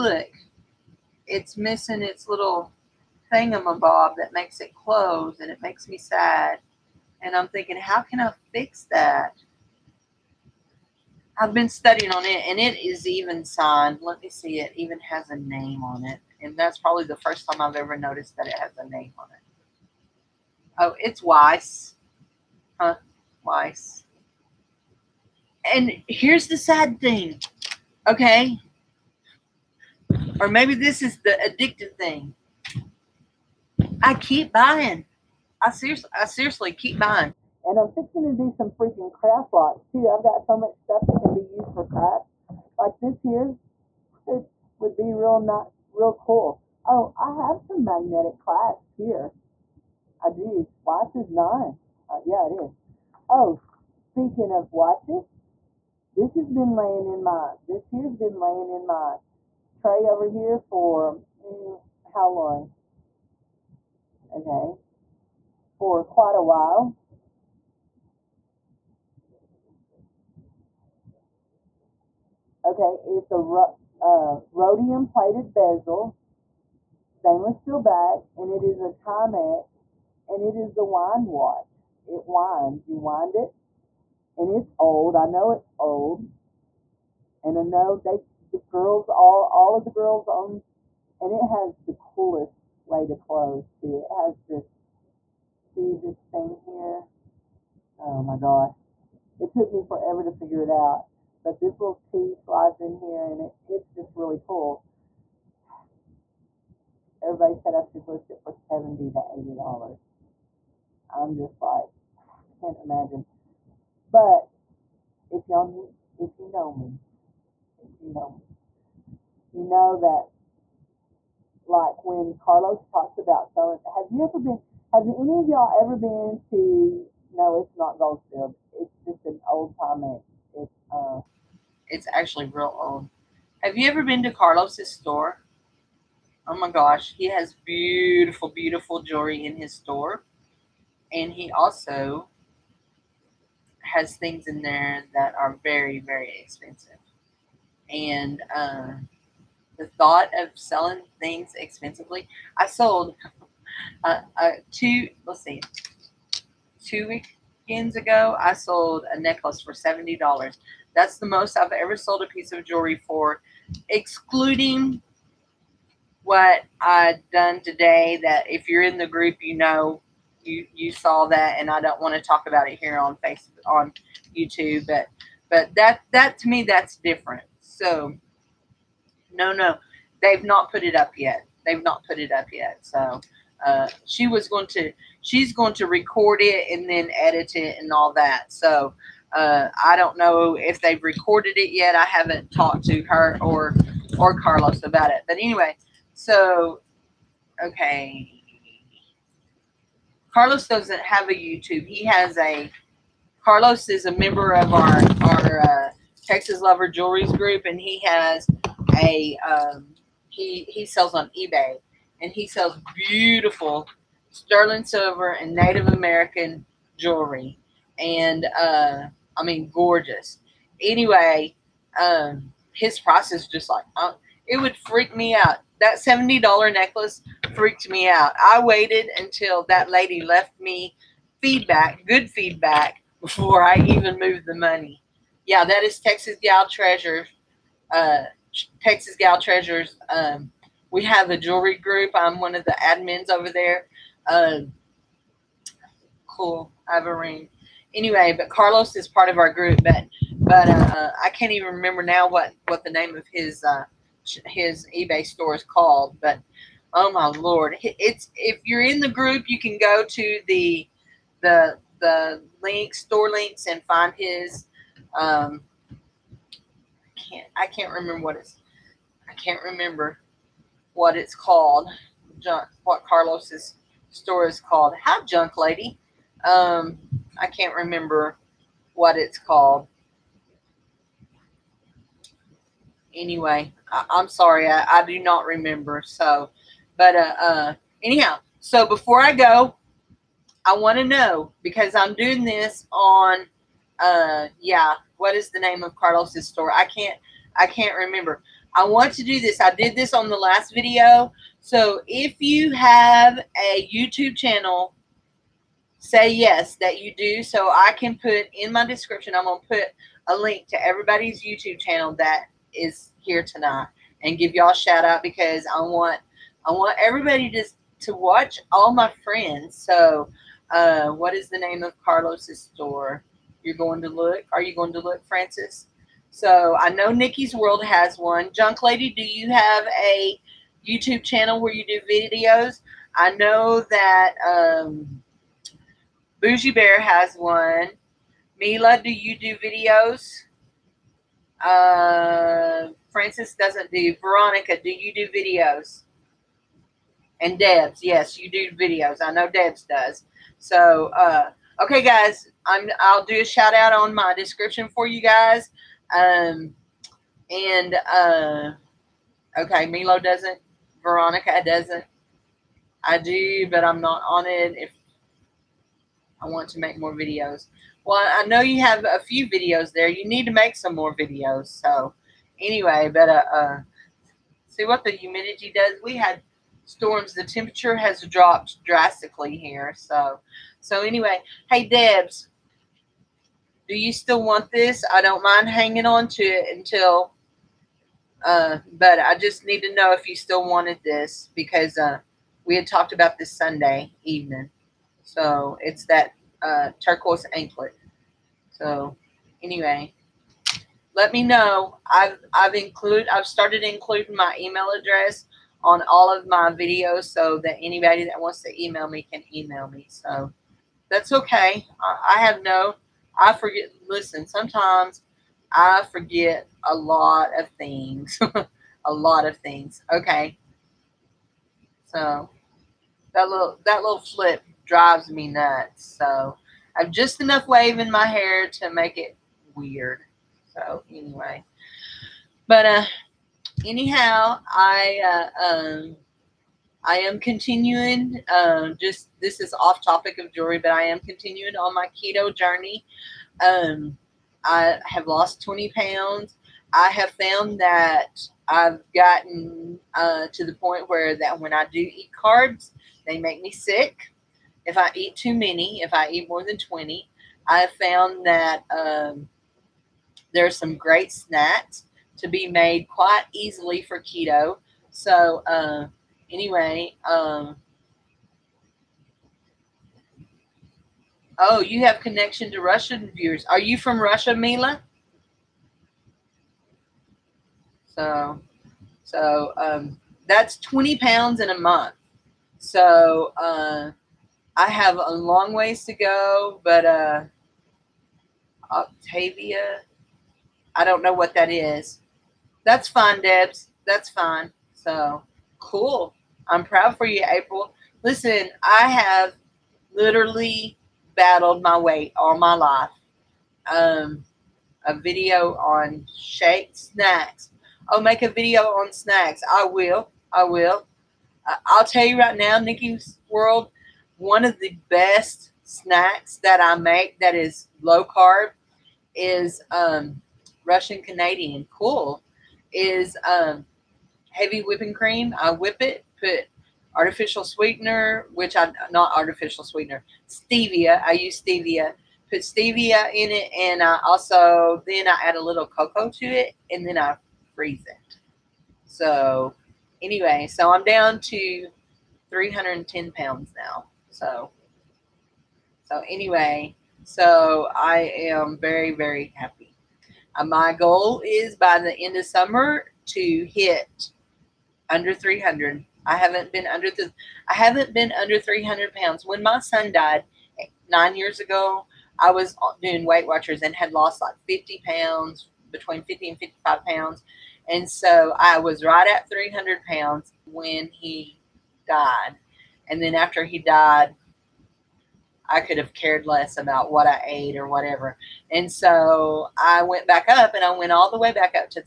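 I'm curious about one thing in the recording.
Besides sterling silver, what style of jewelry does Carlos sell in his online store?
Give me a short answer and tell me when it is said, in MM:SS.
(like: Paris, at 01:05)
Native American, at 03:35.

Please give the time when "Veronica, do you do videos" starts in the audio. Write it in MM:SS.
05:44.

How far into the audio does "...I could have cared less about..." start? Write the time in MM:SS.
09:35.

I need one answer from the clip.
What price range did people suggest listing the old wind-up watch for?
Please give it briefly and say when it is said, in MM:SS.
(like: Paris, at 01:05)
$70 to $80, at 01:48.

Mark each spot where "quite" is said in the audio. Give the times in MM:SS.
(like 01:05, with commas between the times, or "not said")
01:06, 07:43.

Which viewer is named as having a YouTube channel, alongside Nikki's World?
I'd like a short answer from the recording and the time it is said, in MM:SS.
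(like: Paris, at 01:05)
Boujee Bear, at 05:36.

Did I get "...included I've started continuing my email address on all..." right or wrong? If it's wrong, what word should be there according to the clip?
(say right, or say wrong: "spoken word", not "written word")
wrong: "including", not "continuing".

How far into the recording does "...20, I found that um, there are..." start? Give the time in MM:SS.
07:36.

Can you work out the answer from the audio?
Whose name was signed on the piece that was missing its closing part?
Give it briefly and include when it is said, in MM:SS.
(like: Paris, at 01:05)
Weiss, at 00:21.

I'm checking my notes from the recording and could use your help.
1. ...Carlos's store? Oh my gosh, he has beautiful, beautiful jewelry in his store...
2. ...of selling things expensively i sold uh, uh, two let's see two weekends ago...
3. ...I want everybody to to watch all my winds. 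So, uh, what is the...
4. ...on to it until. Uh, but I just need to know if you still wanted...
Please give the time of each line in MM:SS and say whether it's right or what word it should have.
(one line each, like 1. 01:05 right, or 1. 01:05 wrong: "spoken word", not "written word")
1. 02:14 right
2. 02:30 right
3. 05:16 wrong: "friends", not "winds"
4. 06:26 right.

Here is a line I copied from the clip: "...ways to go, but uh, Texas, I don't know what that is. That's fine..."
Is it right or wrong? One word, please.
wrong.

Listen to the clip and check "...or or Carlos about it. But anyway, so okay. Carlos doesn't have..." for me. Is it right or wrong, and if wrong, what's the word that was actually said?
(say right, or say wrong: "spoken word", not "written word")
right.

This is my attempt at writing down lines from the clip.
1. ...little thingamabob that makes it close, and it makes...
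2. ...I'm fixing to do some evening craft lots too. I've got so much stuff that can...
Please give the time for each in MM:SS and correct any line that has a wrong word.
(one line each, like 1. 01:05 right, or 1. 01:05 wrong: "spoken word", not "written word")
1. 00:02 right
2. 00:37 wrong: "freaking", not "evening".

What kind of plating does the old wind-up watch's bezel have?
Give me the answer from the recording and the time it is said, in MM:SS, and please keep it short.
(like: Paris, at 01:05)
Rhodium, at 01:14.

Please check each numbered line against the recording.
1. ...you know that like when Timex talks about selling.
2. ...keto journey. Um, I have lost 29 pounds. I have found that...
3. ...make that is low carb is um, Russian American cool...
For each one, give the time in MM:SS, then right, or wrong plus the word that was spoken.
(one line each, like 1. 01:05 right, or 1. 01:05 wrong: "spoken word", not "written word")
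1. 01:59 wrong: "Carlos", not "Timex"
2. 07:22 wrong: "20", not "29"
3. 08:36 wrong: "Canadian", not "American".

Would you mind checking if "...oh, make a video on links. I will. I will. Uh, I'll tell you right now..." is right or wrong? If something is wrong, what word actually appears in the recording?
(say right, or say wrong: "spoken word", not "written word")
wrong: "snacks", not "links".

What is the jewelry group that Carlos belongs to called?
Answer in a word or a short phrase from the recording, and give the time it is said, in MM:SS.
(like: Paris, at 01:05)
Texas Lover Jewelries, at 03:26.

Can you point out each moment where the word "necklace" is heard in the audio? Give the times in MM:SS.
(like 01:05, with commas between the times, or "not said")
02:39, 03:46.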